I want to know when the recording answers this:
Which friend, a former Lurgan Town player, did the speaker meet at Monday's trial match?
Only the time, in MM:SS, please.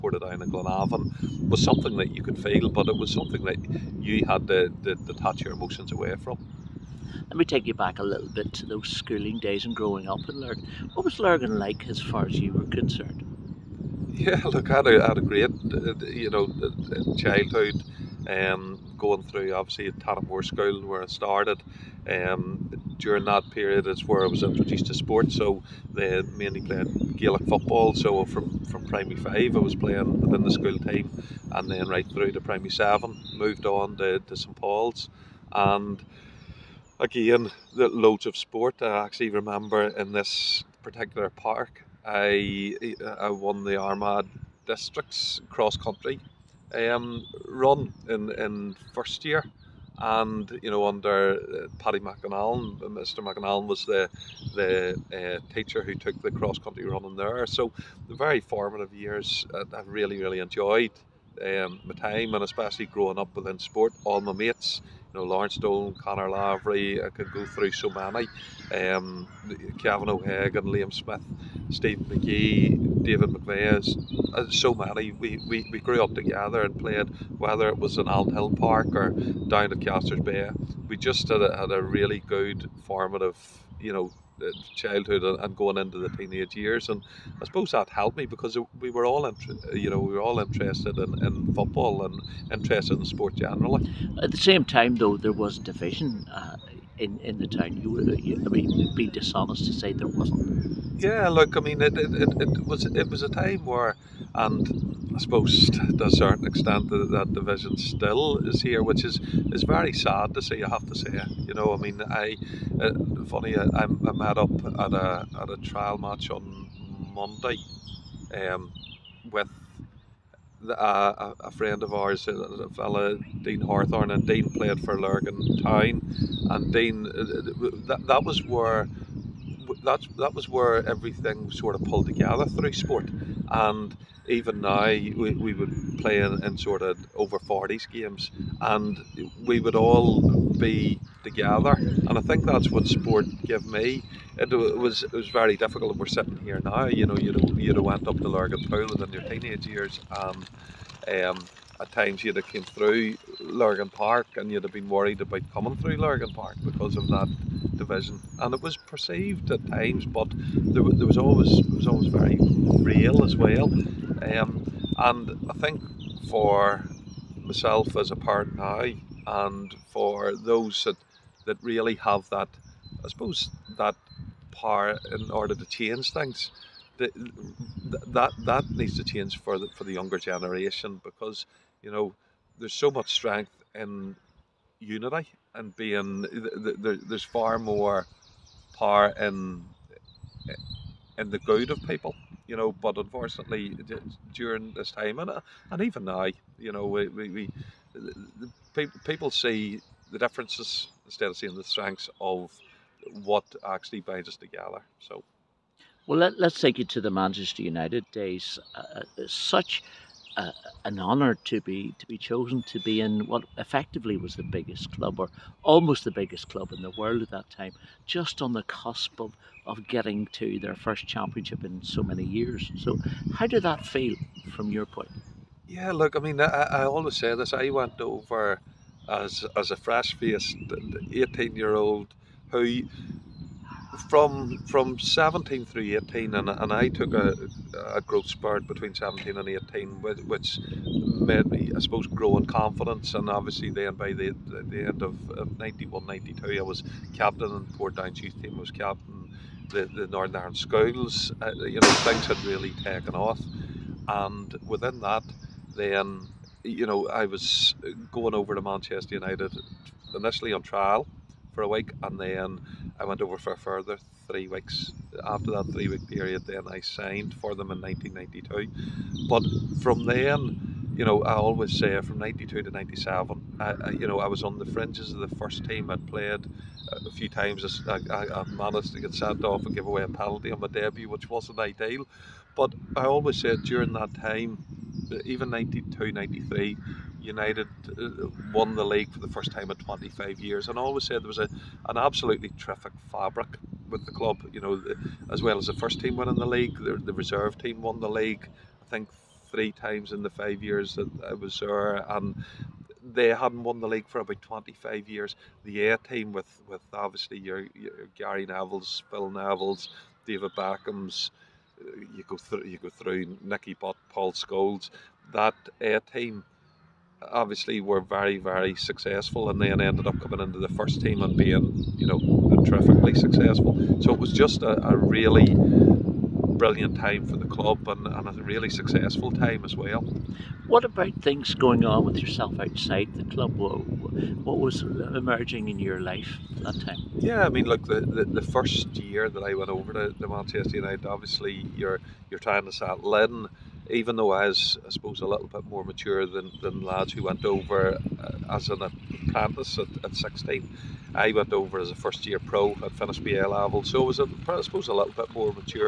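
02:03.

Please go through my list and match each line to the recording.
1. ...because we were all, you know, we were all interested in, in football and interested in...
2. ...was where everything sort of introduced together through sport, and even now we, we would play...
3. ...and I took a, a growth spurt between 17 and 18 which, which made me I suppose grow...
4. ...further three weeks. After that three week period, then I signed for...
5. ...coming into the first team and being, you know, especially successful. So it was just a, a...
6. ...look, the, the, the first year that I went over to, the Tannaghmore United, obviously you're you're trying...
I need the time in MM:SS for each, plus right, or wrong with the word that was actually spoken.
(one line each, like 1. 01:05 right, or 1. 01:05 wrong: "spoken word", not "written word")
1. 01:28 right
2. 02:10 wrong: "pulled", not "introduced"
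3. 03:56 right
4. 04:23 right
5. 05:20 wrong: "terrifically", not "especially"
6. 05:37 wrong: "Manchester", not "Tannaghmore".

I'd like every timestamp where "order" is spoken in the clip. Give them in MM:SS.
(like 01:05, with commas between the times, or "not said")
02:55.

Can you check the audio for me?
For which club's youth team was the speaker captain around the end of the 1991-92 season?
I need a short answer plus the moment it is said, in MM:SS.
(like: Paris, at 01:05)
Portadown, at 04:07.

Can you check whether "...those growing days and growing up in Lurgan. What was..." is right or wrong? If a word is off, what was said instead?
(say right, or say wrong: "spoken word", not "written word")
wrong: "schooling", not "growing".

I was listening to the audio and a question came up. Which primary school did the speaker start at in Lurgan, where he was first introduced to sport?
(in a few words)
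Tannaghmore School.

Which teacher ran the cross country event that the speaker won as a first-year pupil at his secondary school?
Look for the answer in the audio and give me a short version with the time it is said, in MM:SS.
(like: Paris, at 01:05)
Paddy McAnallen, at 00:51.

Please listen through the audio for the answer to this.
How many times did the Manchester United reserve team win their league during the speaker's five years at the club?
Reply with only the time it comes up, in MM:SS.
04:59.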